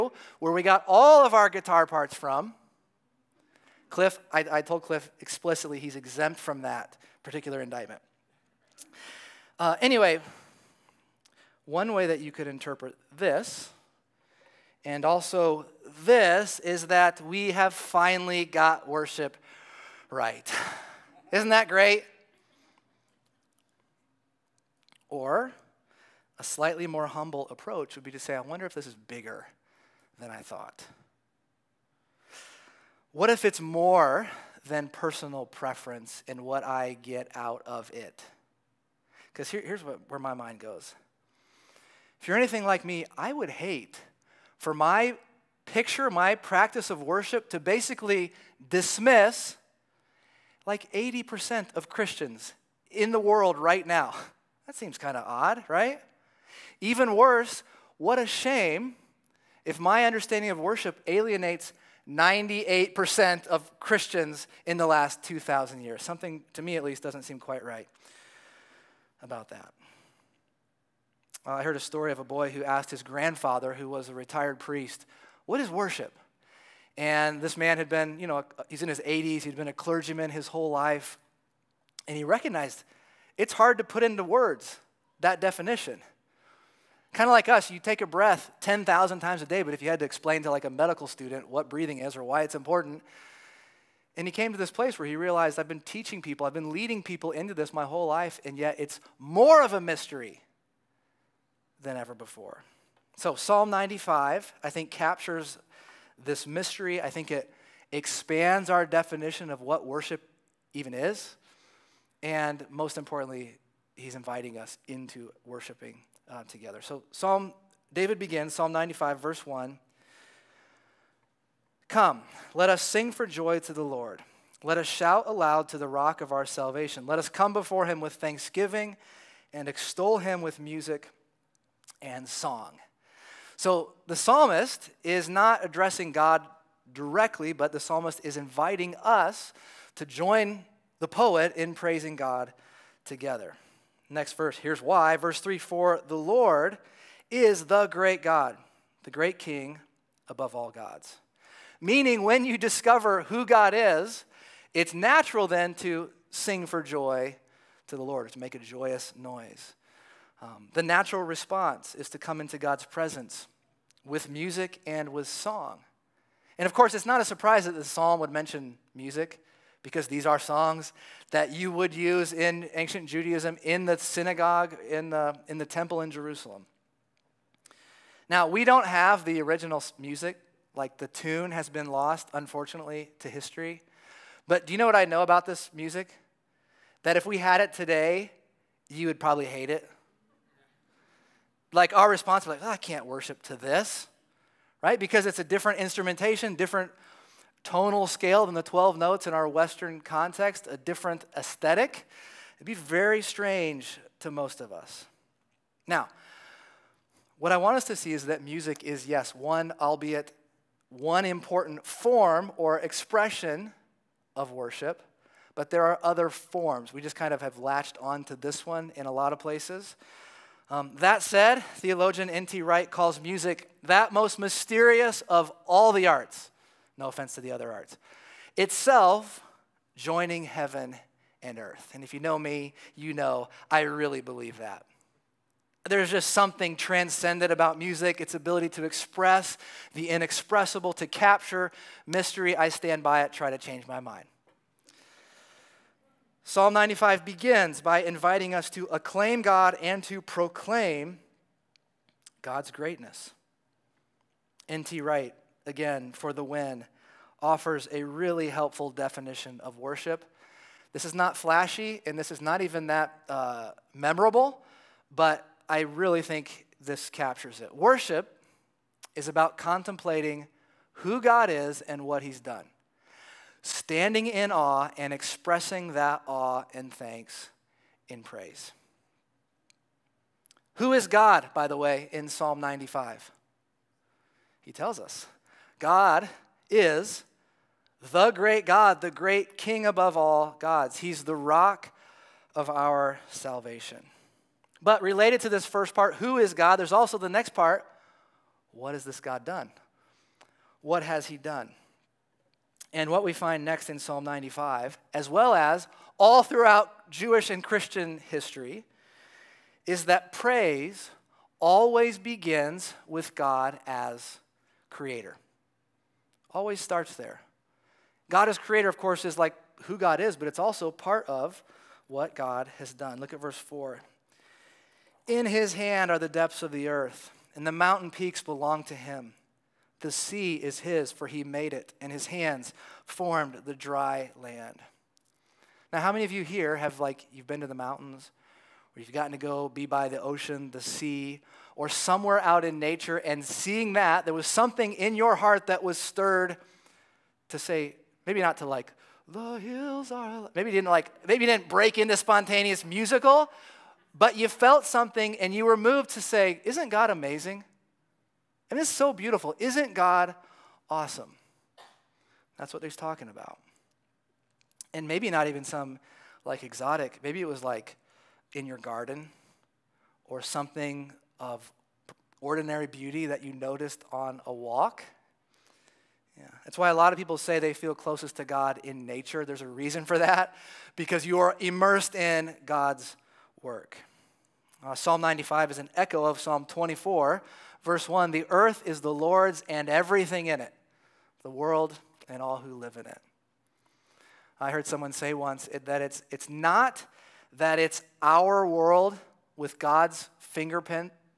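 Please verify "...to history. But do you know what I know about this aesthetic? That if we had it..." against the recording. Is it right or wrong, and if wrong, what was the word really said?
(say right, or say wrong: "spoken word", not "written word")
wrong: "music", not "aesthetic".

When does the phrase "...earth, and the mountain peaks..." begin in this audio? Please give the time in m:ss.
5:26.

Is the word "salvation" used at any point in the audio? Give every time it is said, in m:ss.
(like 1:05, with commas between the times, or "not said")
2:06, 4:53.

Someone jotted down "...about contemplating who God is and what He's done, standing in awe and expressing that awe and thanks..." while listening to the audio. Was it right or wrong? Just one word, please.
right.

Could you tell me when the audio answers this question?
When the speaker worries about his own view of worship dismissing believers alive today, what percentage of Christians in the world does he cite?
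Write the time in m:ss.
0:50.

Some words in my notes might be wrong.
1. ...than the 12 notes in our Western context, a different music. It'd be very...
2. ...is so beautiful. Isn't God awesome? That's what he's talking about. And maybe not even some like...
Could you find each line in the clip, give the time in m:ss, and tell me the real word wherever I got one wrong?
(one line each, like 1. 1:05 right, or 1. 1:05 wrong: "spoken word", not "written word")
1. 3:18 wrong: "aesthetic", not "music"
2. 5:58 right.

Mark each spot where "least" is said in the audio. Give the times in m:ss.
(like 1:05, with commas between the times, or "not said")
1:06.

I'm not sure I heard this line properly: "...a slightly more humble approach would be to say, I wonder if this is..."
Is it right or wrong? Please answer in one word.
right.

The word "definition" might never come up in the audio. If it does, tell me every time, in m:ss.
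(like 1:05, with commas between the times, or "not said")
1:25, 1:48, 4:18.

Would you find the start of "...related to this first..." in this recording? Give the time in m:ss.
4:55.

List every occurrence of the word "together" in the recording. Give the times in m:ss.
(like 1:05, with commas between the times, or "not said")
1:56, 2:23.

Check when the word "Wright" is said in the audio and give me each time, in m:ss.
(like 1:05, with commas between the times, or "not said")
3:42, 4:15.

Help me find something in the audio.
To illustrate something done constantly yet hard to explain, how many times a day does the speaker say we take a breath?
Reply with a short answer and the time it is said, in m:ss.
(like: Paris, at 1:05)
10,000, at 1:28.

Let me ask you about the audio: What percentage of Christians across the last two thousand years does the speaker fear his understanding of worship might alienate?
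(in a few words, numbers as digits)
98%.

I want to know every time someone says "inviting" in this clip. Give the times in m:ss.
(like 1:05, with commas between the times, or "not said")
1:54, 2:18, 4:08.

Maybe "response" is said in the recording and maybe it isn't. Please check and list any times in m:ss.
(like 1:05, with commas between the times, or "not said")
2:41, 3:12.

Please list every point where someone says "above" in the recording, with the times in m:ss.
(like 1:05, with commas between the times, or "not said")
2:30, 4:49.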